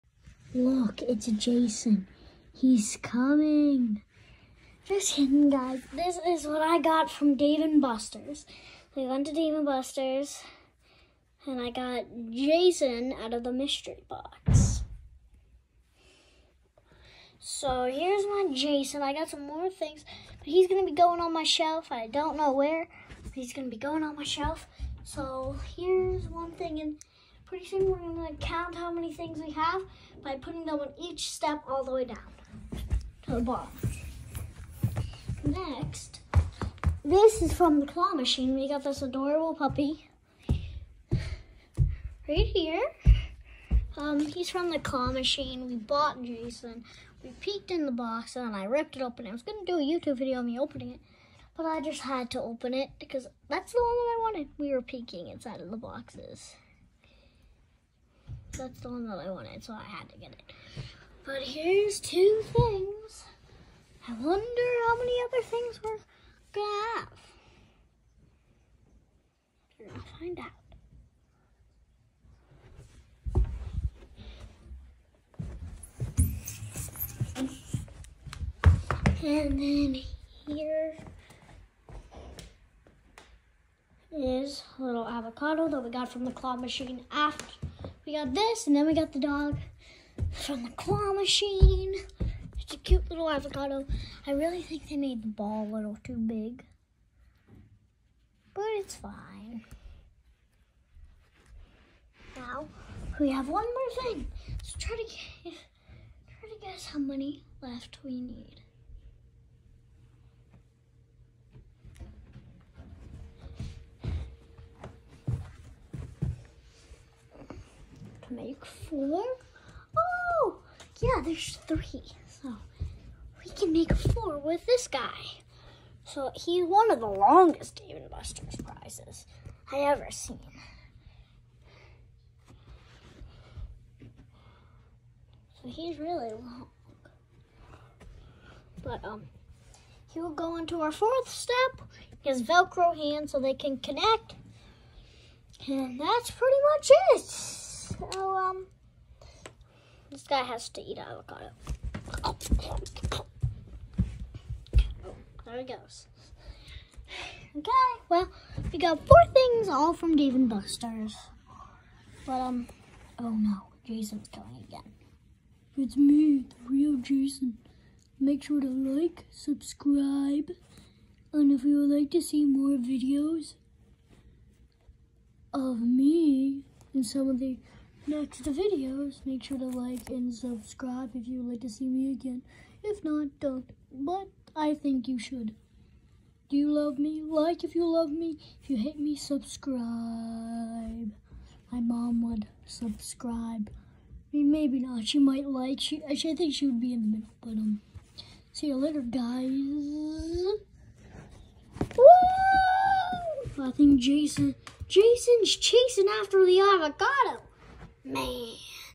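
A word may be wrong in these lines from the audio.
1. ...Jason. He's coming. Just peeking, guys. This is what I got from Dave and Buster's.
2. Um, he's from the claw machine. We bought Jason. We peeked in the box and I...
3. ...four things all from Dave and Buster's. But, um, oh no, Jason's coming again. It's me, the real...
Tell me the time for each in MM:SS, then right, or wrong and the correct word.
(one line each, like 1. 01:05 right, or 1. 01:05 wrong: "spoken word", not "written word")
1. 00:01 wrong: "kidding", not "peeking"
2. 00:43 right
3. 02:39 right.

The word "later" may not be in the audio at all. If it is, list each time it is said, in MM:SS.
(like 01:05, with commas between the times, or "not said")
03:18.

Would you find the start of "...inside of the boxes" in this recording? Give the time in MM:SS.
00:55.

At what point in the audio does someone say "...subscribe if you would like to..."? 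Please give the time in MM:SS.
03:00.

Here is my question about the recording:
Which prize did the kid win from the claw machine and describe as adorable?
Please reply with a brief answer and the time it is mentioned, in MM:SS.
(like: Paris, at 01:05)
Puppy, at 00:39.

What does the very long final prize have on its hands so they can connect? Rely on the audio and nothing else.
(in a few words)
Velcro.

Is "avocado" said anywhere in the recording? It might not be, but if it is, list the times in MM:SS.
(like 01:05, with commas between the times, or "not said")
01:25, 01:33, 02:30, 03:26.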